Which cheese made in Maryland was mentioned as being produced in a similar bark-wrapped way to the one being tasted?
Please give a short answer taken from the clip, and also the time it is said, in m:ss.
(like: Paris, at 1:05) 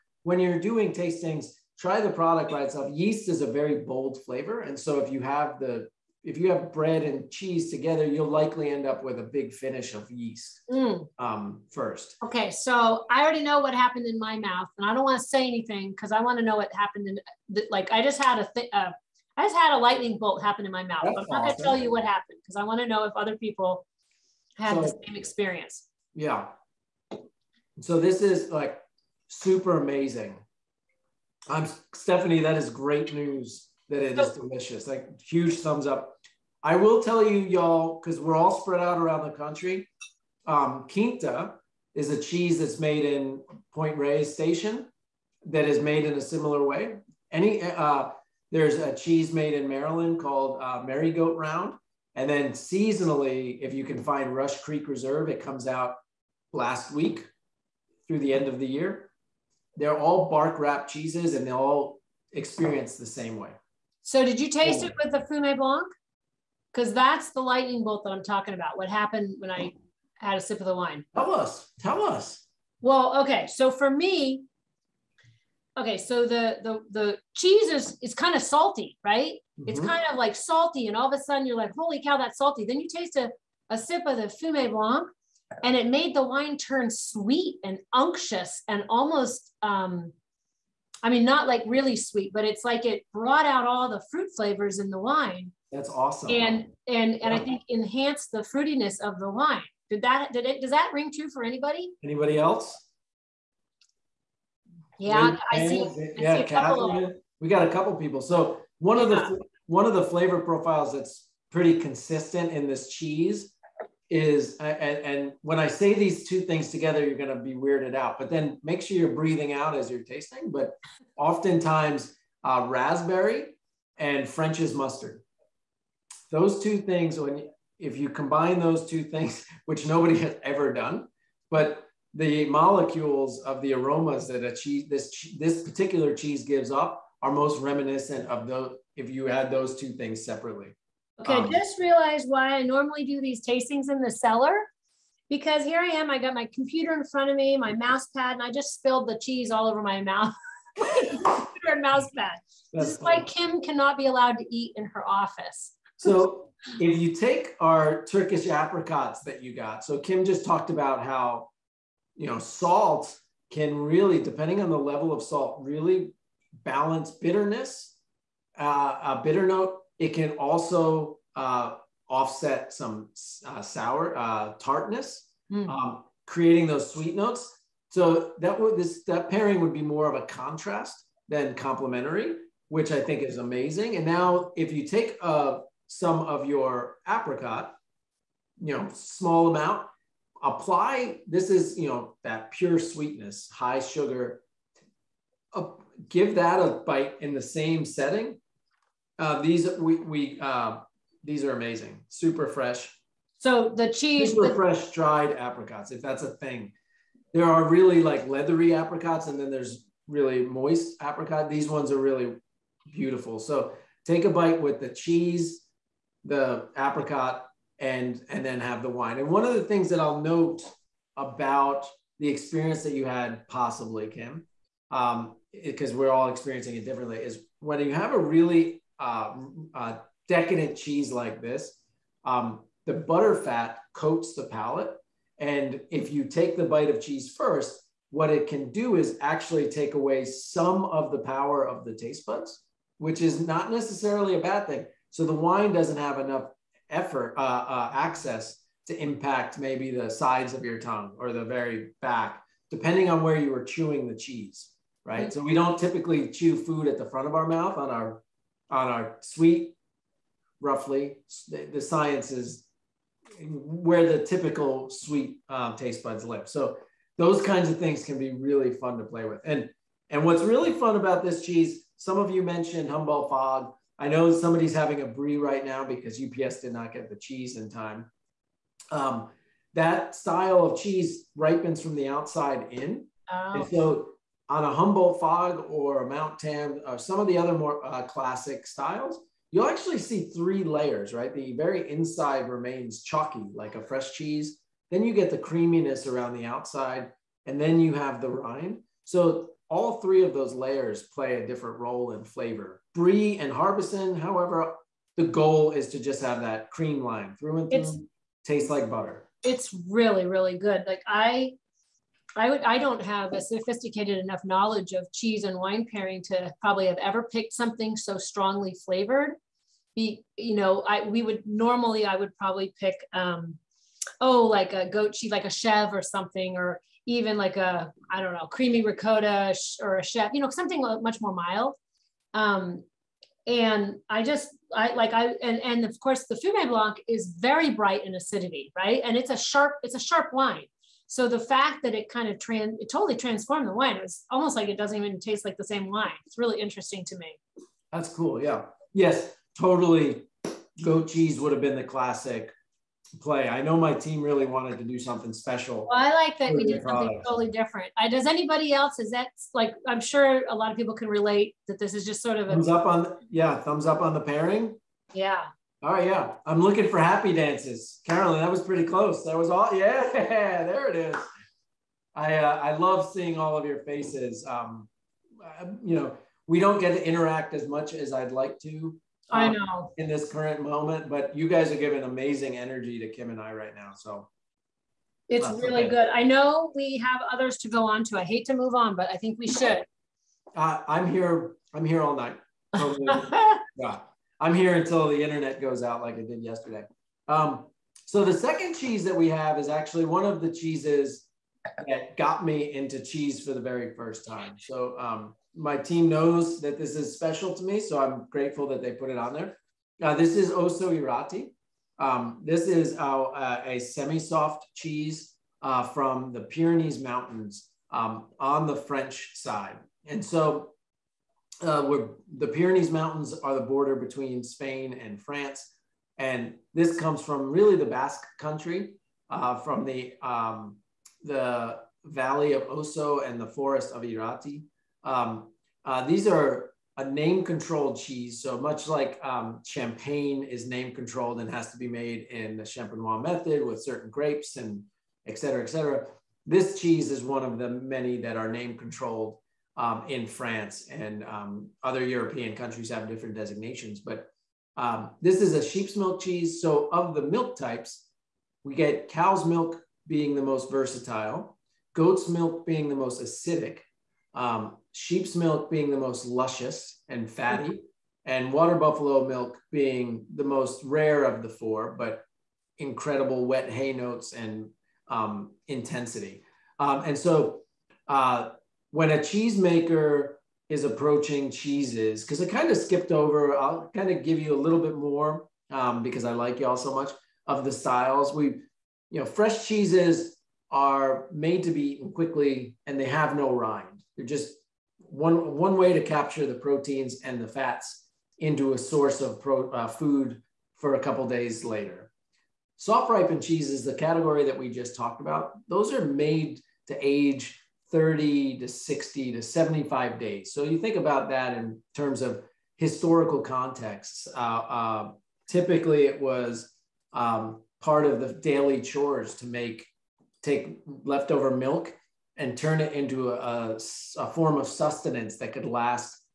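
Merry Goat Round, at 0:50.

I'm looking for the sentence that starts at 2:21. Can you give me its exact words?
Okay, um, I just realized why I normally do these tastings in the cellar because here I am.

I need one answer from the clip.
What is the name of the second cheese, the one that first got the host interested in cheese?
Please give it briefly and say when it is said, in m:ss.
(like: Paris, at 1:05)
Ossau-Iraty, at 6:50.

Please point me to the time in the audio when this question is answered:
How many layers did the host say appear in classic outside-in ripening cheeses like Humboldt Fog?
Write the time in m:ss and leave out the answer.
4:50.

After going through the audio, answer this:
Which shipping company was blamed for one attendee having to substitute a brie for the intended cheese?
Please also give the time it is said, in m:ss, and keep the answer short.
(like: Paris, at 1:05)
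UPS, at 4:36.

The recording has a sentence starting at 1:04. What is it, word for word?
So did you taste it with the Fume Blanc?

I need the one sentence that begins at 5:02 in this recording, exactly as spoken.
Brie and Harbison, however, the goal is to just have that cream line through and through.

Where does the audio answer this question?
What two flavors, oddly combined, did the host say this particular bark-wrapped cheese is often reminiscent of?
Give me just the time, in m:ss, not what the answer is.
2:02.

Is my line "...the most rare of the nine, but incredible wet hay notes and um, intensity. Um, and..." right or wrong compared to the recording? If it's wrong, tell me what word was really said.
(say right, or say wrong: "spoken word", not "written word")
wrong: "four", not "nine".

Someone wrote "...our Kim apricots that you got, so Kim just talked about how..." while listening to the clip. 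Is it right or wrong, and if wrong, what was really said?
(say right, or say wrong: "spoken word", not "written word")
wrong: "Turkish", not "Kim".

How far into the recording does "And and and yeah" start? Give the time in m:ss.
1:36.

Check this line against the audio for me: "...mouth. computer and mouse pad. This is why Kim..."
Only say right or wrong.
right.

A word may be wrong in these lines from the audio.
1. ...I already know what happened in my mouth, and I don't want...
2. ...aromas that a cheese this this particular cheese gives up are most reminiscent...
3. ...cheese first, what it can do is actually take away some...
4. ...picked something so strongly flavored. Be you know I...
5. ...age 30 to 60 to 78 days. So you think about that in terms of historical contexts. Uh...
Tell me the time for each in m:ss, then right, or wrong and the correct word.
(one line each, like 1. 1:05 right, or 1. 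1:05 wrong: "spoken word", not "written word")
1. 0:13 right
2. 2:13 right
3. 3:57 right
4. 5:17 right
5. 8:27 wrong: "75", not "78".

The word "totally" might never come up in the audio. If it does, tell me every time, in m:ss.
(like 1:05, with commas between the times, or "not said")
5:42, 5:49, 5:57.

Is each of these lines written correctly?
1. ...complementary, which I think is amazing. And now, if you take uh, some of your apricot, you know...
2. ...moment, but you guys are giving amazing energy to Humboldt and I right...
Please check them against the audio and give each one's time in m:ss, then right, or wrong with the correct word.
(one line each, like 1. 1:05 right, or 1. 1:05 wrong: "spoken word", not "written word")
1. 3:01 right
2. 6:20 wrong: "Kim", not "Humboldt".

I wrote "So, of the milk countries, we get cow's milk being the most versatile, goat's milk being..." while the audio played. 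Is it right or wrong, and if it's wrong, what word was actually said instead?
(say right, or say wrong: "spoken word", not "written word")
wrong: "types", not "countries".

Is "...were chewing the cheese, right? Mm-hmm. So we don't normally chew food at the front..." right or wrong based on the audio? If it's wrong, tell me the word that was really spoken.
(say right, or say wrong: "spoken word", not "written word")
wrong: "typically", not "normally".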